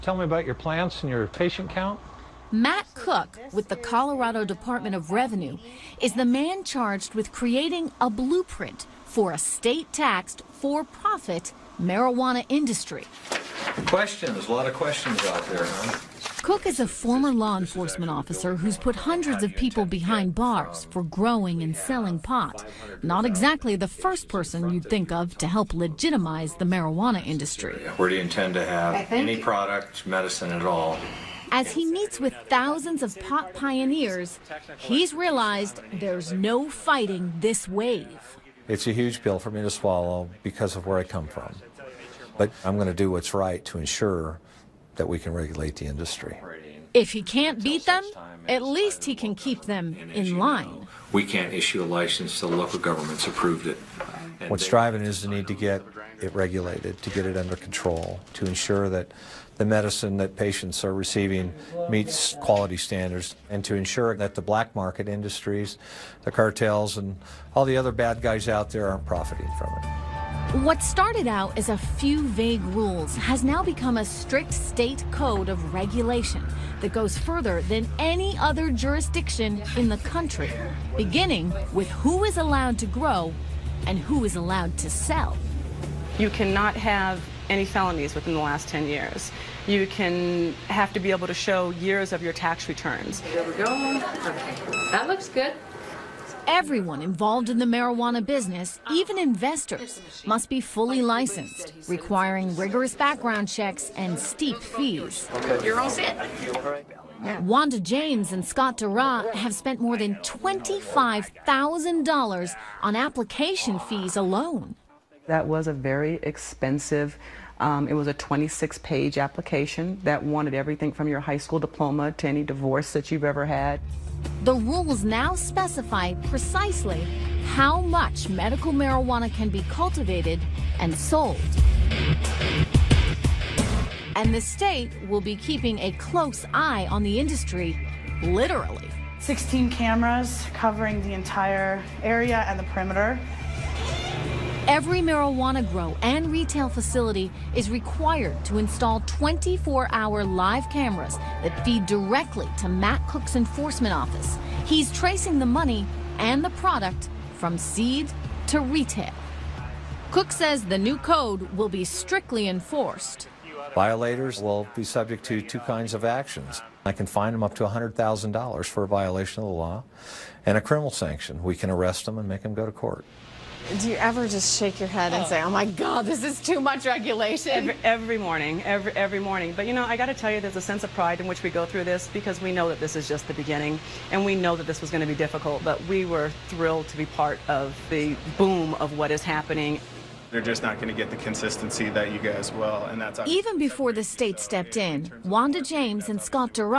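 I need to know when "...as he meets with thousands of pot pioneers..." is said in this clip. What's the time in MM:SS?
00:31.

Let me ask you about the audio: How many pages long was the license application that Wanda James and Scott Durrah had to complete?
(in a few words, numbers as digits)
26.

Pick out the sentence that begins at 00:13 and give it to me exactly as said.
Questions, a lot of questions out there, huh?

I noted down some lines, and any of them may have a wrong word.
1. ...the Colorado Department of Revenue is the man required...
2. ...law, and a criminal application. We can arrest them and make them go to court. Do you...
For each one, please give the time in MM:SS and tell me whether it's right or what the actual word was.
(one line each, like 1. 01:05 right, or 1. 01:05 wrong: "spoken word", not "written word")
1. 00:03 wrong: "charged", not "required"
2. 02:49 wrong: "sanction", not "application".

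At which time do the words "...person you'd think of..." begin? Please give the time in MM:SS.
00:24.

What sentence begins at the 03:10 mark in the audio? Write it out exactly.
They're just not going to get the consistency that you guys will, and that's even before the state so stepped in.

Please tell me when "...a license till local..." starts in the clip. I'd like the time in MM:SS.
00:51.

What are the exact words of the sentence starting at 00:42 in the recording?
But I'm going to do what's right to ensure that we can regulate the industry.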